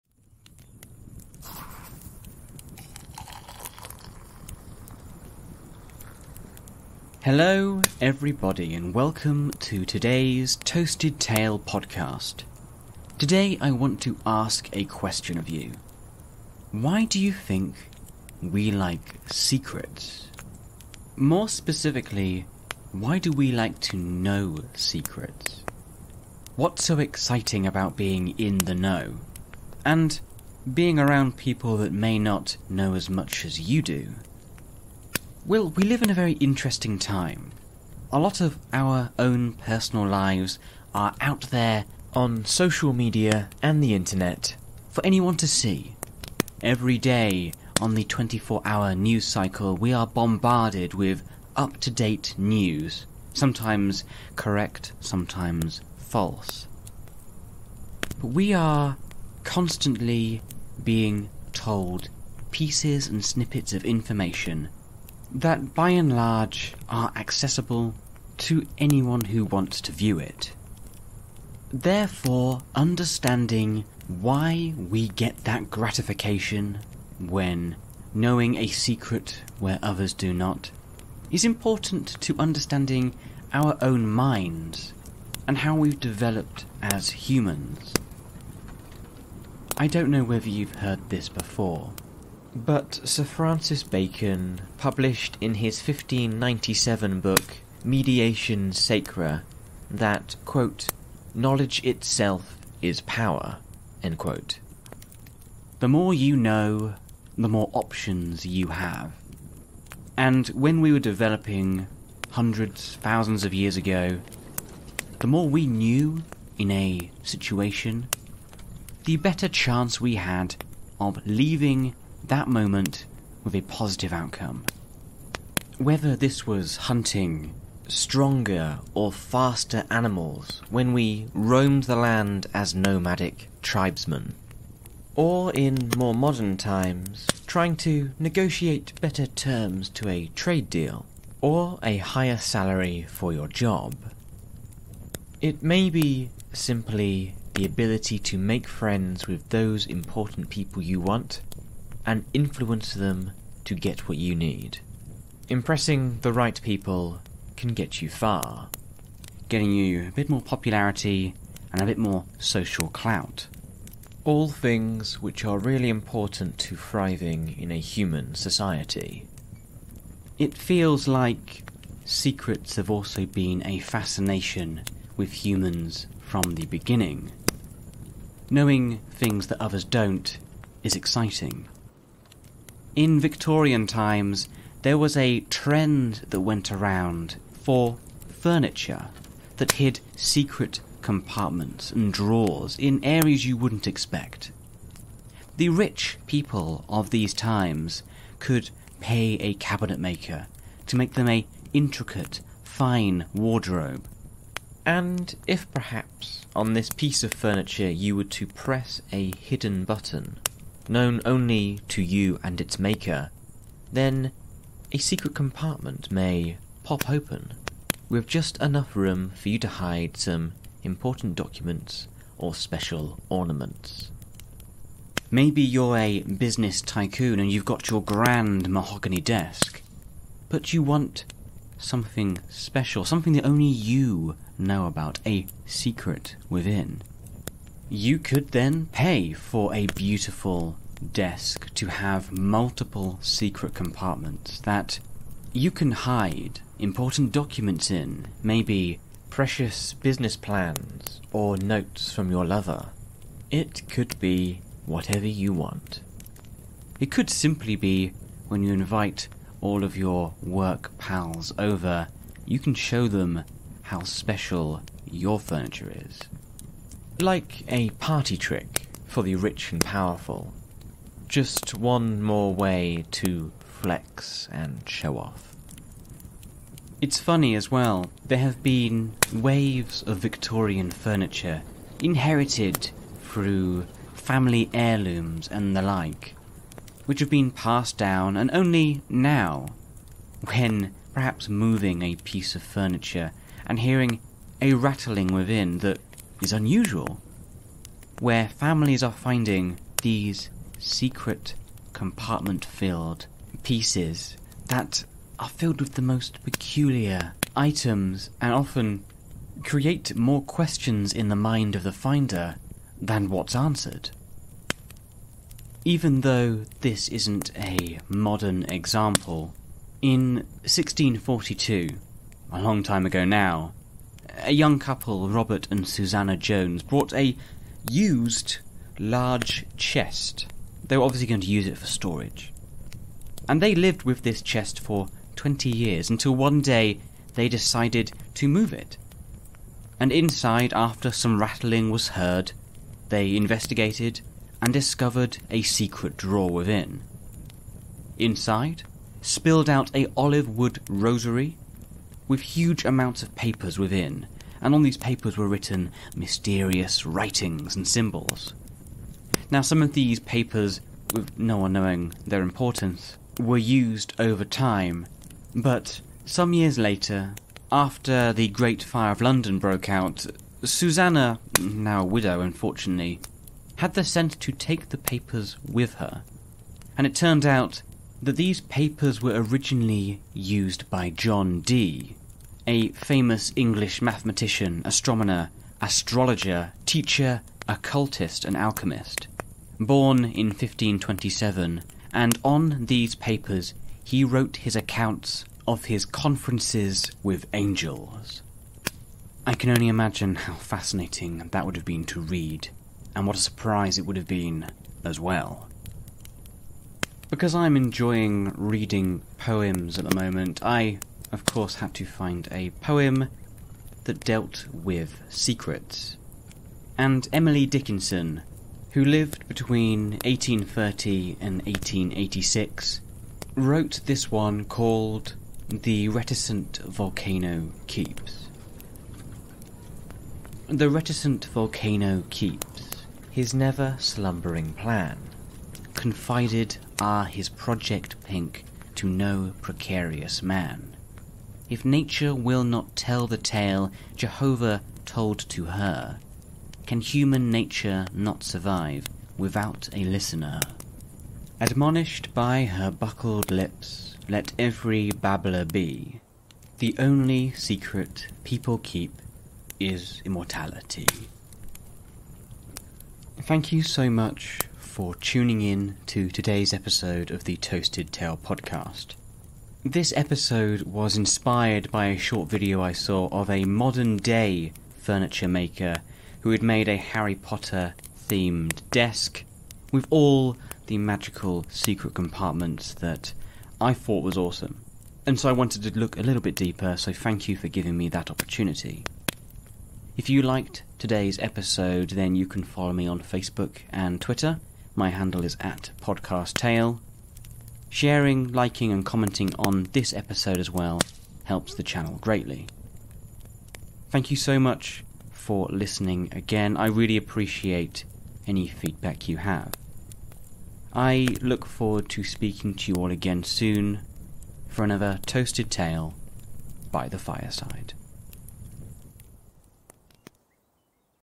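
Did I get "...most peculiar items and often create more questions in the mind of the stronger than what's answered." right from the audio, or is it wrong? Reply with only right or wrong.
wrong.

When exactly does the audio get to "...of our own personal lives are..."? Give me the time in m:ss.
0:38.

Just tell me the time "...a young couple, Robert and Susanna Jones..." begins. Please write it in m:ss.
5:24.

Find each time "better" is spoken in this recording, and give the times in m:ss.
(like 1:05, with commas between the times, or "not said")
1:59, 2:19.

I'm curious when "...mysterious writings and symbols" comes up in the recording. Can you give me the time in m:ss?
5:56.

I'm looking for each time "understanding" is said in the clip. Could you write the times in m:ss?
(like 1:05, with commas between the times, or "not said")
1:12, 1:22.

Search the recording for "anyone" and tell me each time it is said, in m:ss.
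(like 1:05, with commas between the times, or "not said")
0:45, 1:08.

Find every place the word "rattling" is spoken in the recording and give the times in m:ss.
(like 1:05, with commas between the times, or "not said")
4:54, 5:41.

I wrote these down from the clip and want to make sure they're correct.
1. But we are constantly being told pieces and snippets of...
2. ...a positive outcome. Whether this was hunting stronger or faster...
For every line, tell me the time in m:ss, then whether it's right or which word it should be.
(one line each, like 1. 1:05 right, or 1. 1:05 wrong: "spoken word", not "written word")
1. 0:58 right
2. 2:03 right.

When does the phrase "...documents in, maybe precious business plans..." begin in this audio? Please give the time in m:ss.
4:07.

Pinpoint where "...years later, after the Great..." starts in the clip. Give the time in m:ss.
6:06.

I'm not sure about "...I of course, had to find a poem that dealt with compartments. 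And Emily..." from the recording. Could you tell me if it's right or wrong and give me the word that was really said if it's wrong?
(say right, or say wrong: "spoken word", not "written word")
wrong: "secrets", not "compartments".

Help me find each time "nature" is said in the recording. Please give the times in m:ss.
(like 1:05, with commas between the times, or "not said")
7:21, 7:27.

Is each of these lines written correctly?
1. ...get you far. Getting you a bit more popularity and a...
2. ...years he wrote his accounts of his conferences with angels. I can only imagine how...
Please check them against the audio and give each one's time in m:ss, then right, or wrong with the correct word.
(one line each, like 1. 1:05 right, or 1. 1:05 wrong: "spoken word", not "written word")
1. 2:37 right
2. 6:33 wrong: "papers", not "years".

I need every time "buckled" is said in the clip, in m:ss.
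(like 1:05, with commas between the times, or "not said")
7:32.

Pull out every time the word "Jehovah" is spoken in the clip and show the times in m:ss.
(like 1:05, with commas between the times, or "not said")
7:24.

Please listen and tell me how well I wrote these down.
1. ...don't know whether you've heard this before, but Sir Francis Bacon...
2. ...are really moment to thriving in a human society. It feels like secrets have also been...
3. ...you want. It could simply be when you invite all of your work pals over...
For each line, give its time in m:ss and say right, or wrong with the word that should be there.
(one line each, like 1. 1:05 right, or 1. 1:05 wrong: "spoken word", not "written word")
1. 1:29 right
2. 2:45 wrong: "important", not "moment"
3. 4:15 right.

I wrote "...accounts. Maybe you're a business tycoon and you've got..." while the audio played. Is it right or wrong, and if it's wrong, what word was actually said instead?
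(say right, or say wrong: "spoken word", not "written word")
wrong: "ornaments", not "accounts".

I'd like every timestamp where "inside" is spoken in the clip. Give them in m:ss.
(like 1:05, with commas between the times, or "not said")
5:40, 5:48.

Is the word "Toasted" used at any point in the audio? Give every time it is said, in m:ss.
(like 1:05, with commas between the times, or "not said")
0:10, 7:47, 8:35.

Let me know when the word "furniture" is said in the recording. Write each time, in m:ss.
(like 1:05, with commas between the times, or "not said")
3:08, 3:27, 4:25, 4:40, 4:52, 7:54.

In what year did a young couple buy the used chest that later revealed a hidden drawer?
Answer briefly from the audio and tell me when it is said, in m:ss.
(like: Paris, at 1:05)
1642, at 5:20.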